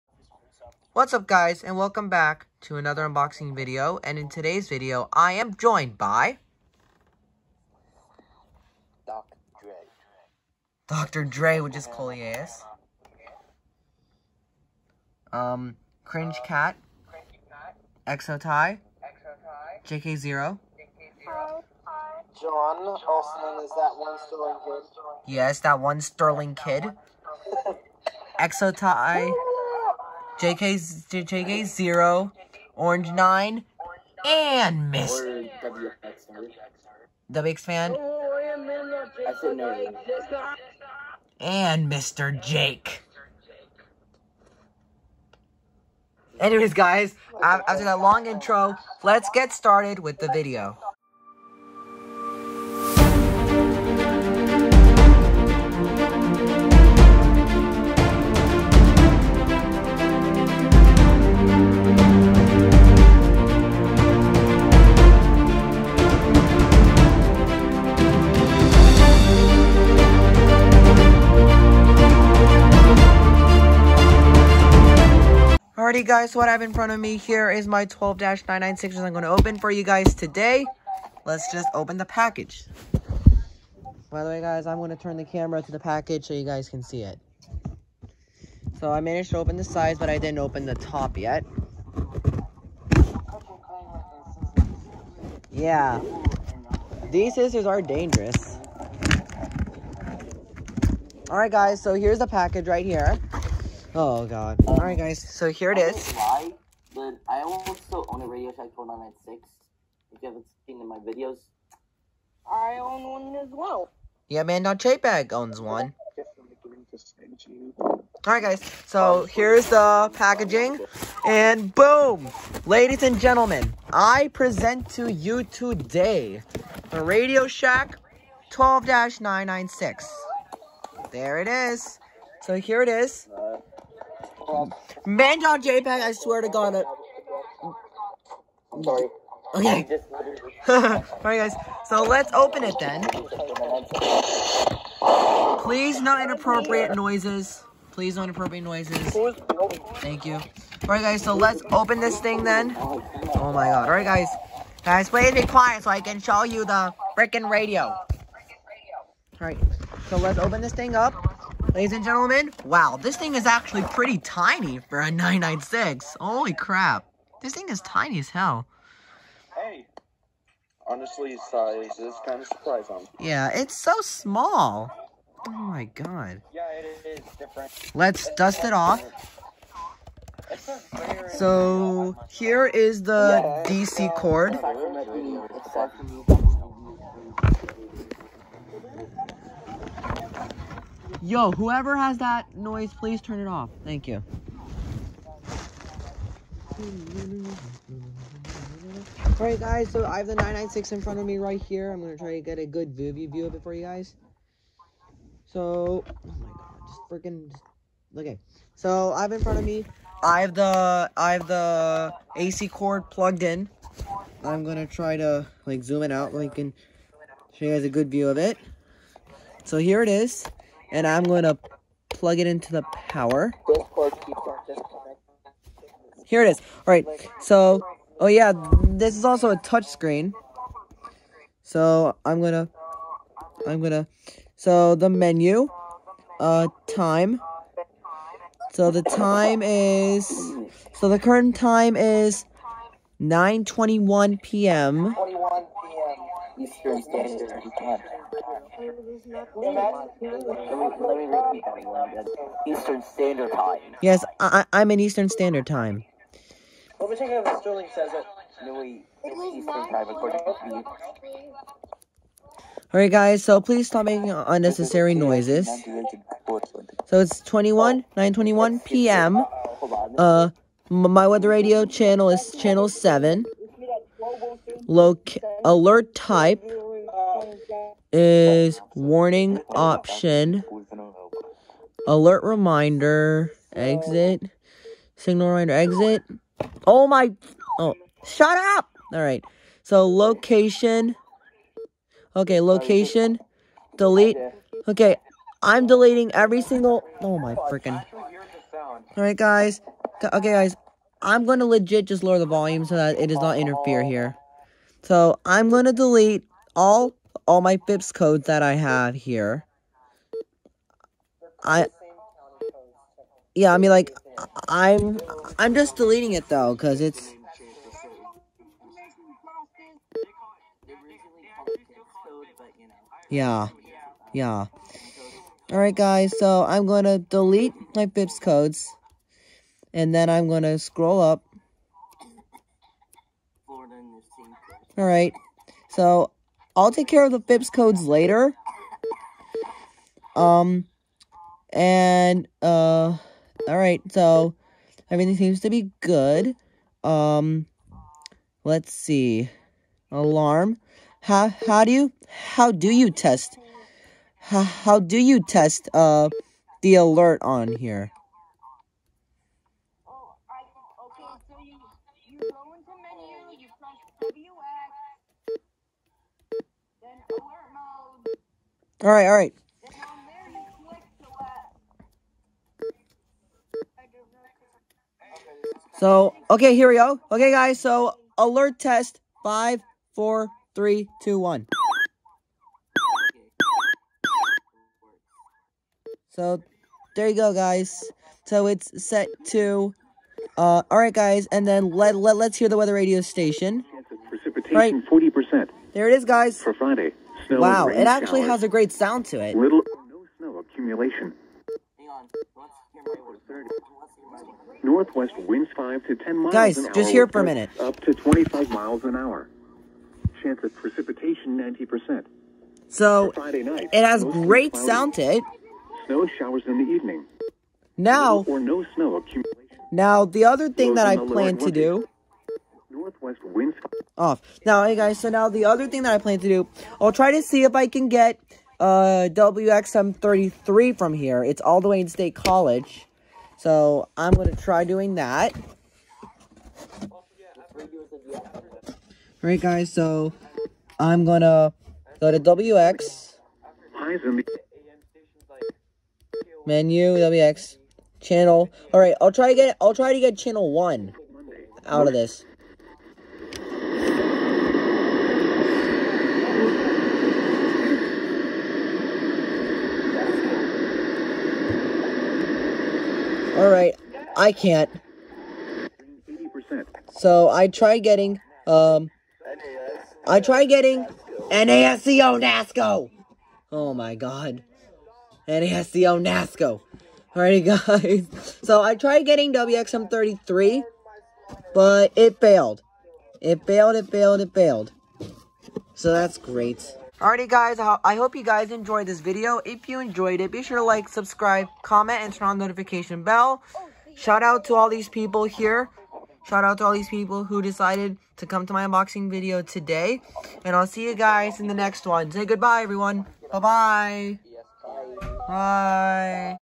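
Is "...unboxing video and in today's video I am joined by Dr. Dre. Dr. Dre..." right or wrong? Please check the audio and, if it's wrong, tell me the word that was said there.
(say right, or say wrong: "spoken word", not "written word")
right.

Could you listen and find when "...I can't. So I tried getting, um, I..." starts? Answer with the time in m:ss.
7:44.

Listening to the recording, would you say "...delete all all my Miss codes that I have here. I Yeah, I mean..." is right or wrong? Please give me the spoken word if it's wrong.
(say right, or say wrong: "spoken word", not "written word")
wrong: "FIPS", not "Miss".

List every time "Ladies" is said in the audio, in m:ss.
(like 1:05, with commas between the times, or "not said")
2:02, 2:41.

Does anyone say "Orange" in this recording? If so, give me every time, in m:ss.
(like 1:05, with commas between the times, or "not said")
0:32.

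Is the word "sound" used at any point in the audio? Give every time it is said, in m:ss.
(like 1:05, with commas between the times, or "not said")
6:38, 6:54.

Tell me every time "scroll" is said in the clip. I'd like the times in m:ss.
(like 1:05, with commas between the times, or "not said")
5:30.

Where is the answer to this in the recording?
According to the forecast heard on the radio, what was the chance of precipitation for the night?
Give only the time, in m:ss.
6:51.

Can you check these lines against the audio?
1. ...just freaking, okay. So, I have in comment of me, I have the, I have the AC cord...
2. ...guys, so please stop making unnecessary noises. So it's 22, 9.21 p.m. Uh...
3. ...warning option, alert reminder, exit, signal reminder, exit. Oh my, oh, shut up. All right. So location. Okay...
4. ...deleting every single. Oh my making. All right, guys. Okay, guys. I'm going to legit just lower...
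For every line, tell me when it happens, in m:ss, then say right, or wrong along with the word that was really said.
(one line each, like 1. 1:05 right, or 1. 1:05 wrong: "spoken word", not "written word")
1. 3:26 wrong: "front", not "comment"
2. 4:23 wrong: "21", not "22"
3. 4:38 right
4. 4:55 wrong: "freaking", not "making".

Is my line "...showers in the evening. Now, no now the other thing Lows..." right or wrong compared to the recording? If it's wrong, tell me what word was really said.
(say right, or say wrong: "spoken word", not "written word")
right.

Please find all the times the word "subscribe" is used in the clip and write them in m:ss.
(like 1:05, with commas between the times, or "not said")
8:11.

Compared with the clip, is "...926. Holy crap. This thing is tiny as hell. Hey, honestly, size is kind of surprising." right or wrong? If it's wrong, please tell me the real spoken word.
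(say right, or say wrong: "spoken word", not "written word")
wrong: "996", not "926".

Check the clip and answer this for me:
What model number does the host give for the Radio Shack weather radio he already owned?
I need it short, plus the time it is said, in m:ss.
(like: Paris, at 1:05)
4996, at 1:48.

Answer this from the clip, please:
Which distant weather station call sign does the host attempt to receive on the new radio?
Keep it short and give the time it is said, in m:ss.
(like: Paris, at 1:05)
WXM33, at 7:09.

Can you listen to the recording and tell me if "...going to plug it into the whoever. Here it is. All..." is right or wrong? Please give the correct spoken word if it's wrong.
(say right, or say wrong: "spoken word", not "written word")
wrong: "power", not "whoever".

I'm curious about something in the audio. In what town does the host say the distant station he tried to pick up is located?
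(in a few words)
State College.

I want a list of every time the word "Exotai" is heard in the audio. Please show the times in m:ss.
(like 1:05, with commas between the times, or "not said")
0:18, 0:28.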